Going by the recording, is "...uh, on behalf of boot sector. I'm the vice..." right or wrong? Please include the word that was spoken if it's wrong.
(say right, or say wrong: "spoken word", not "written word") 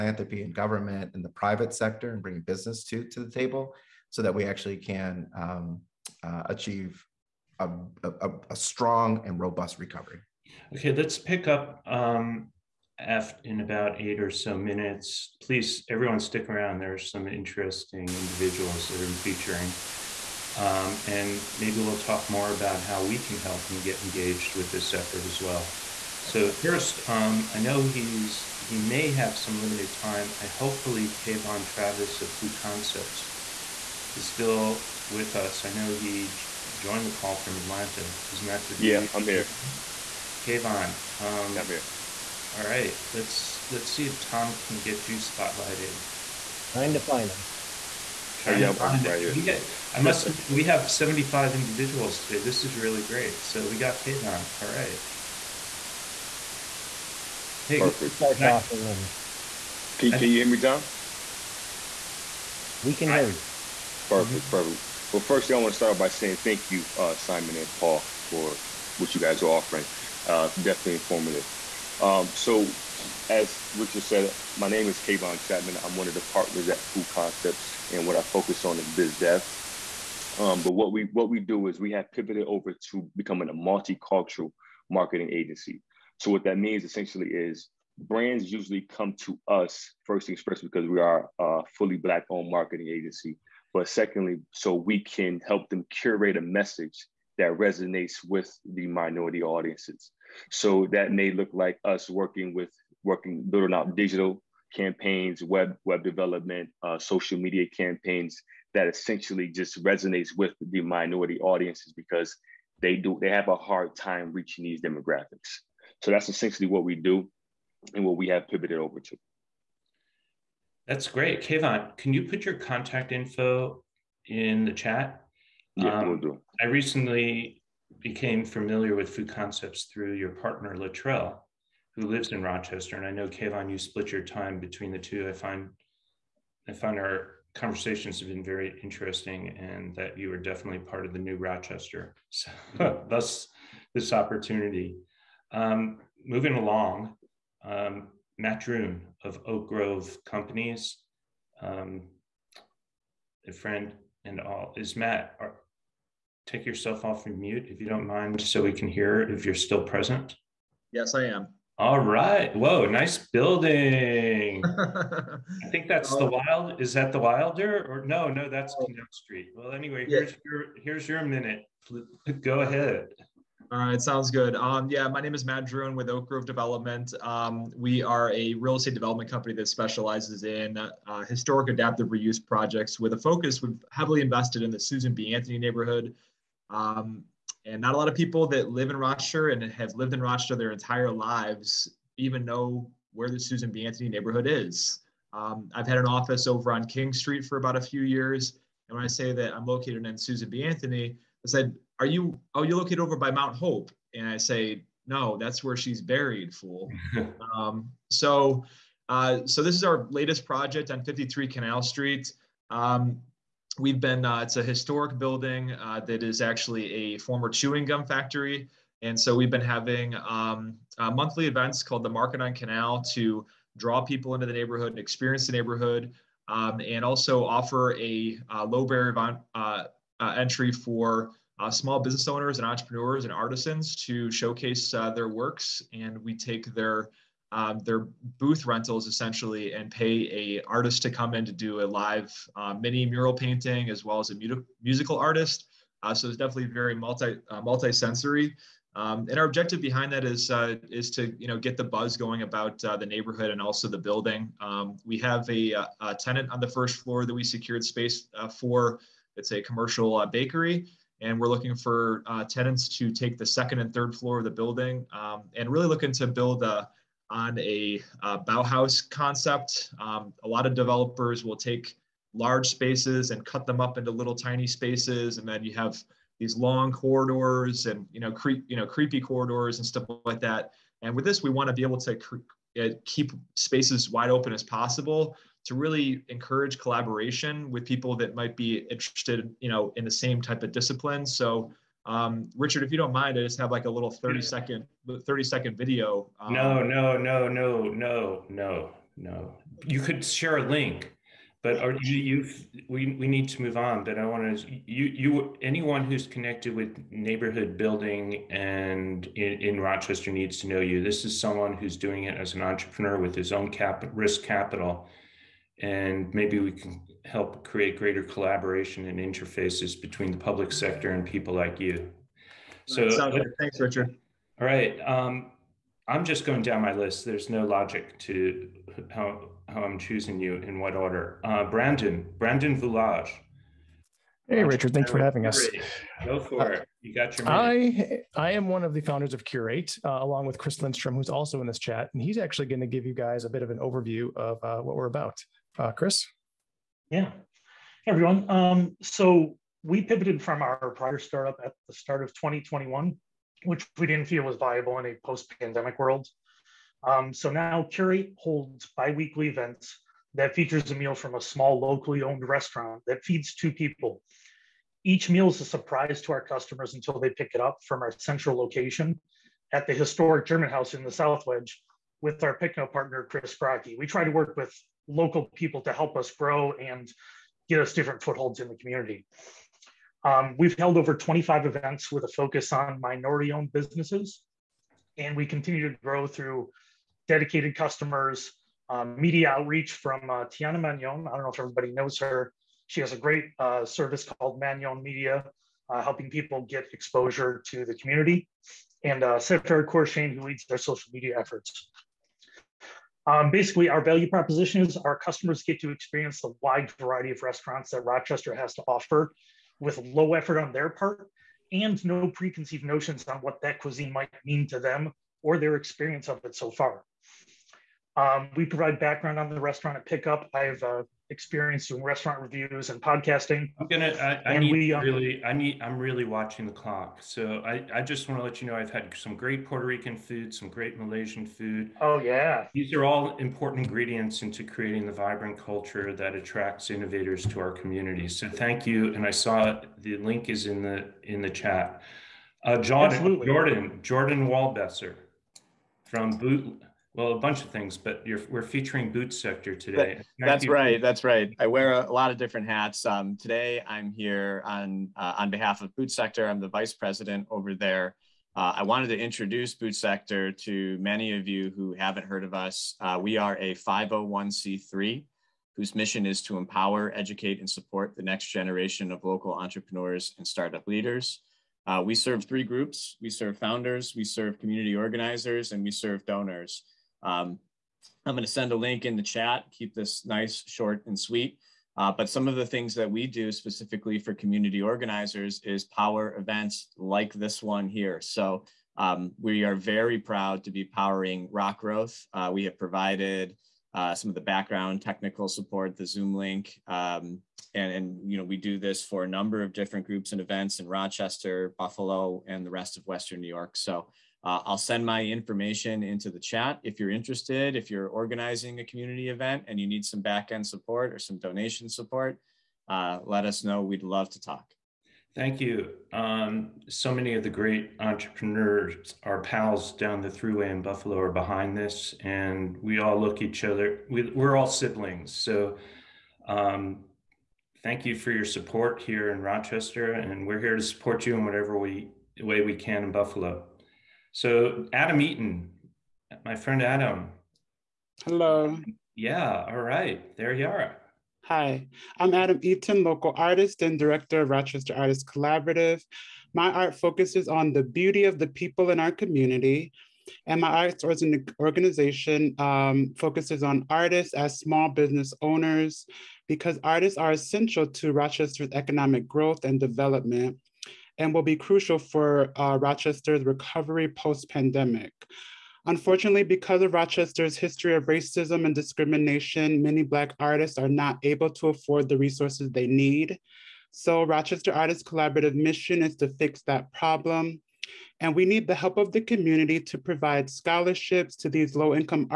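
right.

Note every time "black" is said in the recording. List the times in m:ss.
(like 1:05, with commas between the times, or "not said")
1:31, 9:30.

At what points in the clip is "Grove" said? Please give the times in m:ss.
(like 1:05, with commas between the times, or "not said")
2:29, 2:56.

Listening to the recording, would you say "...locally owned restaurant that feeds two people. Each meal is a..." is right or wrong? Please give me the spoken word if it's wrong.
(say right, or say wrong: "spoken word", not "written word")
right.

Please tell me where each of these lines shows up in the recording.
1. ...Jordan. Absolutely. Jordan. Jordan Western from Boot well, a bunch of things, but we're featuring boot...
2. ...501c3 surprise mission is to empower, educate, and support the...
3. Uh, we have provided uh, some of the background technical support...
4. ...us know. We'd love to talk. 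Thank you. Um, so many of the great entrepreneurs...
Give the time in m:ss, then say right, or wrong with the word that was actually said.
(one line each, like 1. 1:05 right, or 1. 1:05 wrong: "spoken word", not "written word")
1. 7:22 wrong: "Waldbesser", not "Western"
2. 7:43 wrong: "whose", not "surprise"
3. 8:12 right
4. 8:33 right.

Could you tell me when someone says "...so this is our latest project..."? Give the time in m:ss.
3:29.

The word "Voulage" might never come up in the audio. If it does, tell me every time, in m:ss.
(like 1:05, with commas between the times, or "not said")
5:32.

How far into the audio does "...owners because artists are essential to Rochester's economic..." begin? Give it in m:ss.
9:15.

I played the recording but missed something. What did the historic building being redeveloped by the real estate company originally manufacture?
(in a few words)
chewing gum.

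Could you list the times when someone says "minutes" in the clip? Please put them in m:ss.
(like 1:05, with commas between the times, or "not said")
0:14, 2:51.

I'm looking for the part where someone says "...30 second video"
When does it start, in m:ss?
4:55.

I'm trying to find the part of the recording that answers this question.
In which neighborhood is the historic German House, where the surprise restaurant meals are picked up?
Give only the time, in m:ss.
6:11.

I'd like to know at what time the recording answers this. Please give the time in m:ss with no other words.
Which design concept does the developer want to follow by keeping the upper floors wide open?
4:28.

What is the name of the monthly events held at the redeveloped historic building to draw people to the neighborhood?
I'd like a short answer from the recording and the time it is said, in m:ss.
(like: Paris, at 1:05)
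Market on Canal, at 3:42.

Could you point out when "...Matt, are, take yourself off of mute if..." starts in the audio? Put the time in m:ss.
2:34.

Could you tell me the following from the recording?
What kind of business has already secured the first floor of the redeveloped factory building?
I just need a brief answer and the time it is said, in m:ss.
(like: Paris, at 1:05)
commercial bakery, at 4:19.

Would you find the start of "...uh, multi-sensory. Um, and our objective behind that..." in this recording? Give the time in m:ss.
4:07.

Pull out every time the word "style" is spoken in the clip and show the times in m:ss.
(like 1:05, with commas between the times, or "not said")
not said.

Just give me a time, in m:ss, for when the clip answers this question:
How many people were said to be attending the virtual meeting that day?
0:50.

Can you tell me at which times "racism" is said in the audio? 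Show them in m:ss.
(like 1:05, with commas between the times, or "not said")
9:28.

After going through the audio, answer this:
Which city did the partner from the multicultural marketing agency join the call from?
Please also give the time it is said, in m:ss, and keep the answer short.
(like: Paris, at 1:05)
Atlanta, at 0:37.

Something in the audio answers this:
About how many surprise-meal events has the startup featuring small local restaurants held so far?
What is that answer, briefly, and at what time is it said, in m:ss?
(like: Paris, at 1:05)
over 25, at 6:20.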